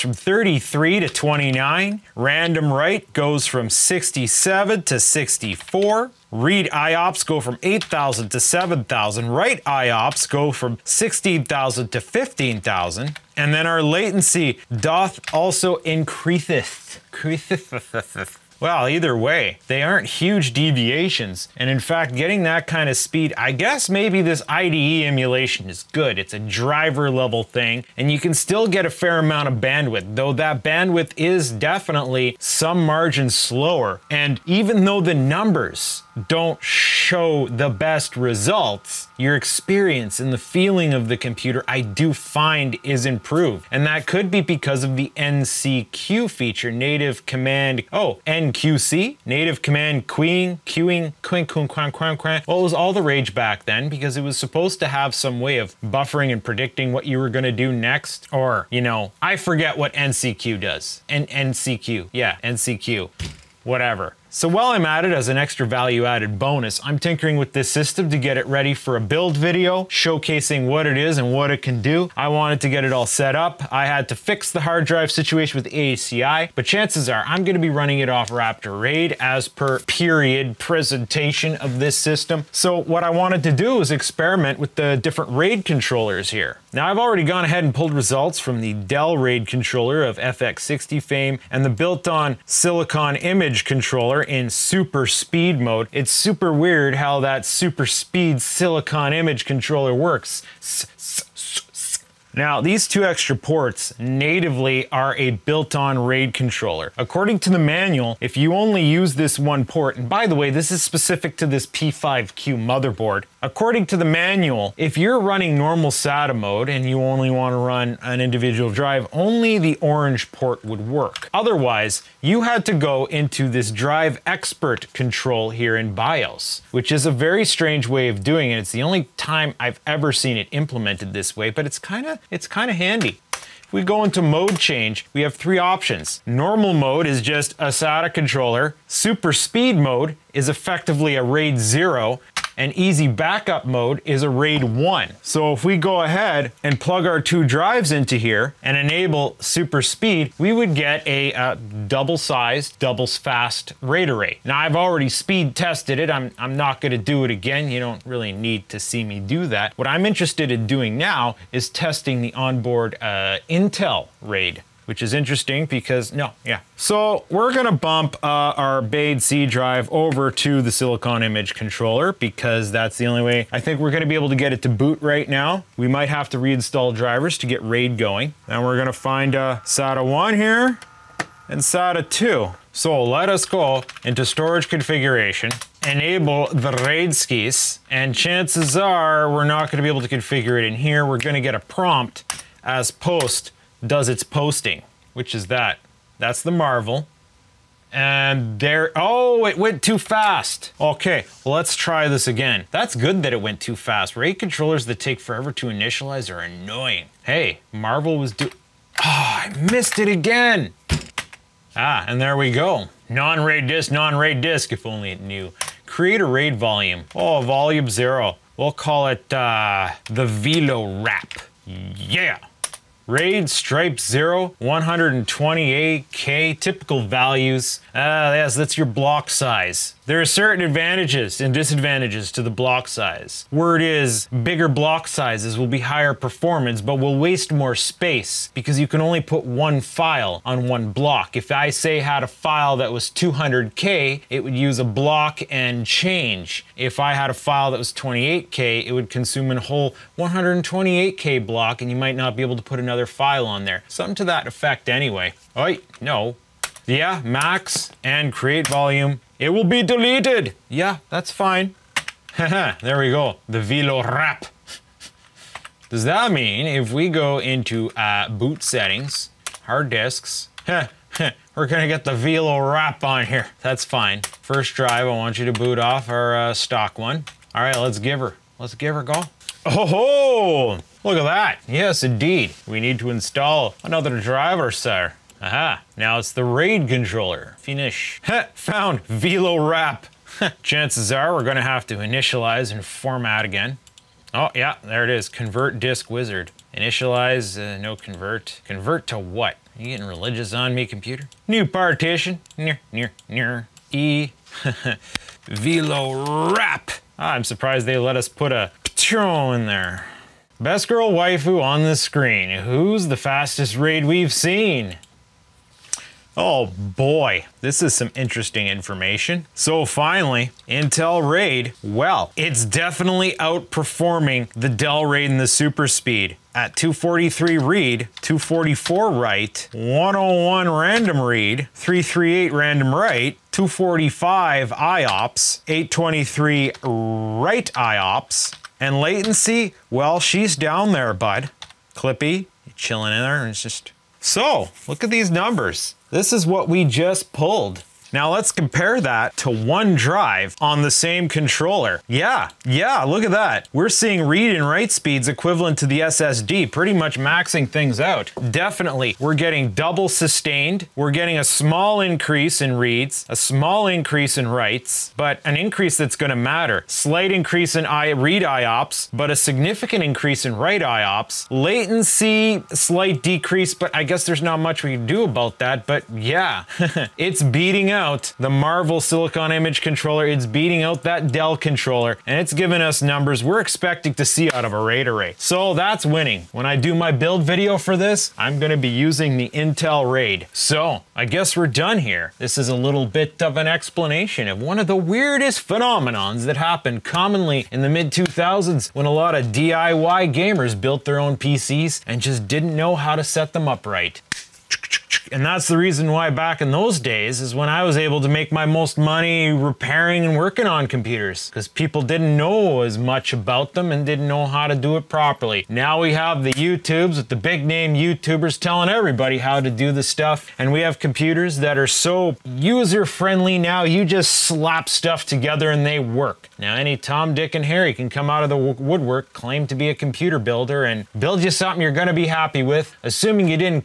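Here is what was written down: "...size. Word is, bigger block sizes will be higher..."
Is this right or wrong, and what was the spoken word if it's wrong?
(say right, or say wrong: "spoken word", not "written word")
right.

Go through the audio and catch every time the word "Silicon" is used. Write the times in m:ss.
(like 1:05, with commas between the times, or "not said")
1:32, 1:38, 2:50, 6:19.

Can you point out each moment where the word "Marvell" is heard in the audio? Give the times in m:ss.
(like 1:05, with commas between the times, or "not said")
3:16, 3:27, 6:18.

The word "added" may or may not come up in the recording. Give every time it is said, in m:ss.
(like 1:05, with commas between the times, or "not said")
1:06.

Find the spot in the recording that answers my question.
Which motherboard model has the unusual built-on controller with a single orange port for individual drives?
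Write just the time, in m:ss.
1:51.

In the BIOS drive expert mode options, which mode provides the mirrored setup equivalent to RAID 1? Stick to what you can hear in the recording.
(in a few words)
Easy backup mode.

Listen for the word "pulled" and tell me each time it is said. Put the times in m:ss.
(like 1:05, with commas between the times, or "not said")
1:27, 5:47.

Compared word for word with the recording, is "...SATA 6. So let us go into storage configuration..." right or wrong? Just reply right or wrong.
wrong.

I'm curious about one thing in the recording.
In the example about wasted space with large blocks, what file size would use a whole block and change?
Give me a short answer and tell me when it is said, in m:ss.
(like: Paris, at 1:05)
200K, at 4:03.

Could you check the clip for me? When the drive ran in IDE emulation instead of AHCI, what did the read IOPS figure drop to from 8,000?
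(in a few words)
7,000.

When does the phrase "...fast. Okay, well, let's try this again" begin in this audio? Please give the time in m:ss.
3:19.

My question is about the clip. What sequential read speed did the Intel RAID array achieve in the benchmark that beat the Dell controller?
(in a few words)
243.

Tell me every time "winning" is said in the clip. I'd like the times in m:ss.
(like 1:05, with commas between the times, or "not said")
6:26.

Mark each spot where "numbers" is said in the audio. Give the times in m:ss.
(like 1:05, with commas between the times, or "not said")
0:35, 5:45, 6:23.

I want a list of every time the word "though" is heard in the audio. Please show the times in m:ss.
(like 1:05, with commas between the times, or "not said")
0:30, 0:34.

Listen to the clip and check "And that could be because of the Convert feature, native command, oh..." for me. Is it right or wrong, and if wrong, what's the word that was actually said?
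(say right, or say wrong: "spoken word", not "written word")
wrong: "NCQ", not "Convert".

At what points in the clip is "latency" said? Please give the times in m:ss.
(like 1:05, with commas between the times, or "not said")
0:13, 5:39, 6:11.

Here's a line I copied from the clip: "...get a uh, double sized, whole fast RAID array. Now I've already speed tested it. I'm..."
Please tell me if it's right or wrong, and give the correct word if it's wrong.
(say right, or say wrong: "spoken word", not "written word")
wrong: "double", not "whole".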